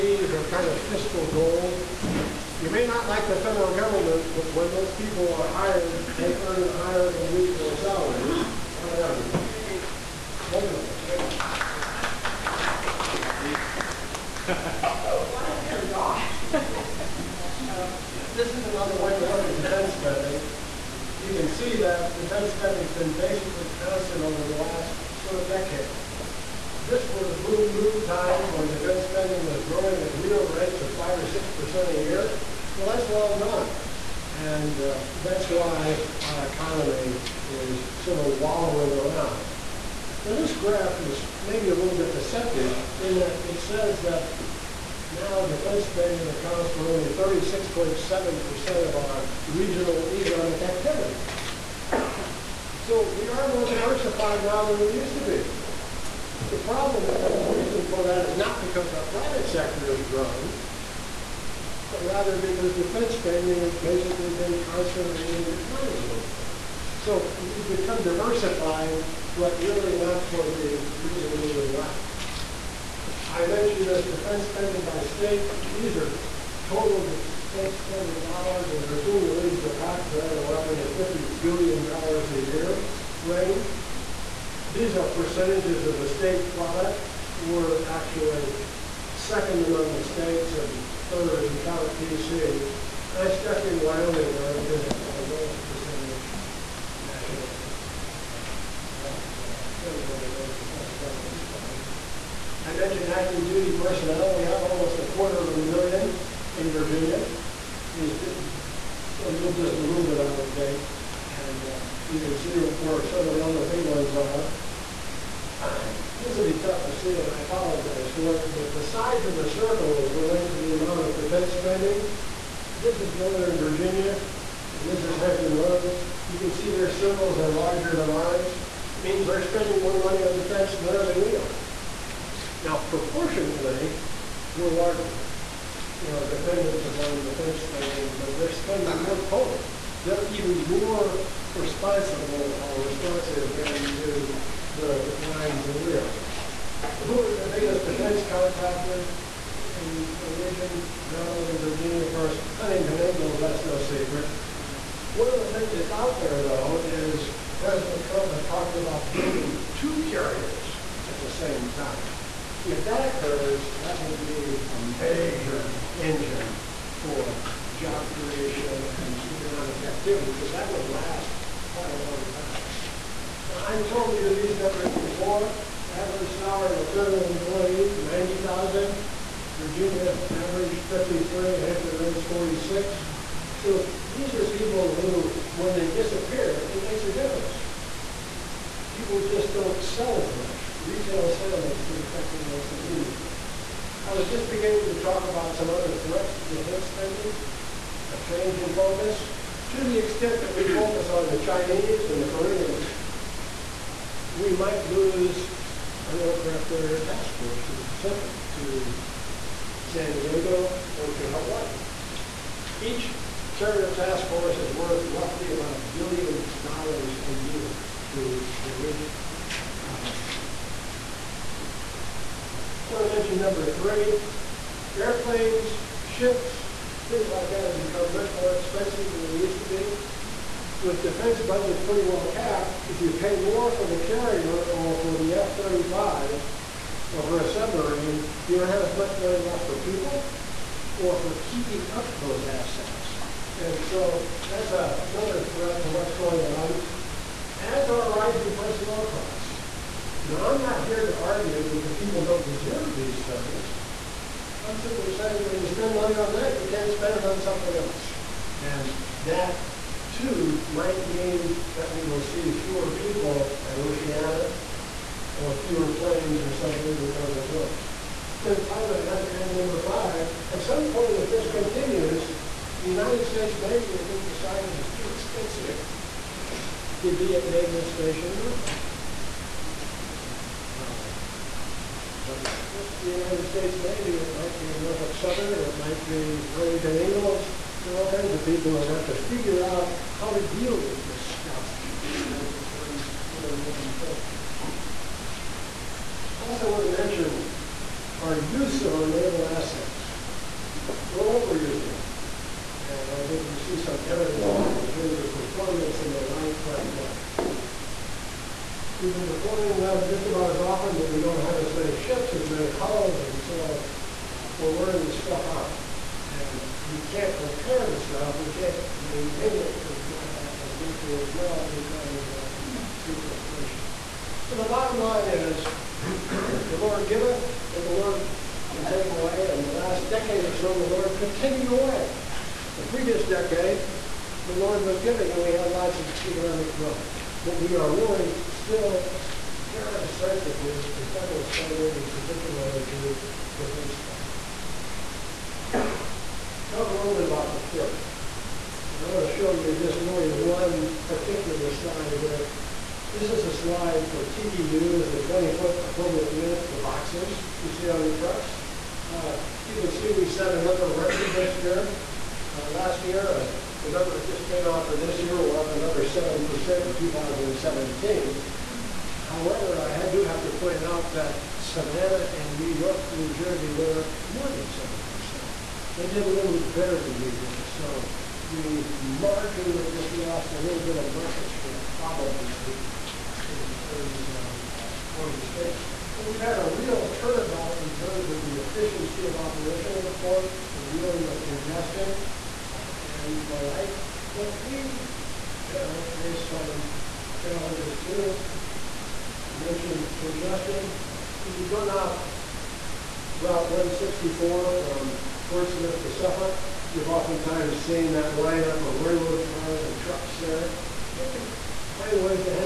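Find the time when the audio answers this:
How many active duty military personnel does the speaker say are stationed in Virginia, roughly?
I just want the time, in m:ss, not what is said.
1:44.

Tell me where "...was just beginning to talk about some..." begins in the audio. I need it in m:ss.
3:14.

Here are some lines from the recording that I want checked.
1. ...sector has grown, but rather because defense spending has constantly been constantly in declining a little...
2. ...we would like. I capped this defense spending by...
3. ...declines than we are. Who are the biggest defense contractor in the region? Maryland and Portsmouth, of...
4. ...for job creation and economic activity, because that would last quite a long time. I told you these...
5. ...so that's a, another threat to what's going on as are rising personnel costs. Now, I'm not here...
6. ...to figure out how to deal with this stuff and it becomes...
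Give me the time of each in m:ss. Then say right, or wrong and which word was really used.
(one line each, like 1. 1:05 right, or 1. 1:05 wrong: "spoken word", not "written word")
1. 0:59 wrong: "basically", not "constantly"
2. 1:11 wrong: "mentioned", not "capped"
3. 2:24 wrong: "Virginia", not "Portsmouth"
4. 2:46 right
5. 4:03 right
6. 4:49 right.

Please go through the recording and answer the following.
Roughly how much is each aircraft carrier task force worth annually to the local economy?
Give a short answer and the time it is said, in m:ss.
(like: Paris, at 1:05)
about a billion dollars, at 3:35.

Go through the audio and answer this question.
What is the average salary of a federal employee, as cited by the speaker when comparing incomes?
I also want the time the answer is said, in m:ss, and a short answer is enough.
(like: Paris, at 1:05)
90000, at 2:58.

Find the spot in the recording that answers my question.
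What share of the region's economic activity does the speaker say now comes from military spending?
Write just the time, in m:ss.
0:47.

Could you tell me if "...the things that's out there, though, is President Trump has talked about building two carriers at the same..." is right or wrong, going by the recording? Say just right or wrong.
right.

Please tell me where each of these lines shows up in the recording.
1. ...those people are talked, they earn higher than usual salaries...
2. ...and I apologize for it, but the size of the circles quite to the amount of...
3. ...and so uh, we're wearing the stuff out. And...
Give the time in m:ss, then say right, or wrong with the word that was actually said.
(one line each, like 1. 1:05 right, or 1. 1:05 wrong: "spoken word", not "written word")
1. 0:04 wrong: "hired", not "talked"
2. 1:57 wrong: "relate", not "quite"
3. 5:13 right.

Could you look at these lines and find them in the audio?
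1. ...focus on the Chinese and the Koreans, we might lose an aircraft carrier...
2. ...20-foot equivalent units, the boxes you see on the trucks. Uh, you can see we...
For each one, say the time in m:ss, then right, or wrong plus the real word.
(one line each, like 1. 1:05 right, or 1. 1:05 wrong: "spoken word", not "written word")
1. 3:20 right
2. 5:55 right.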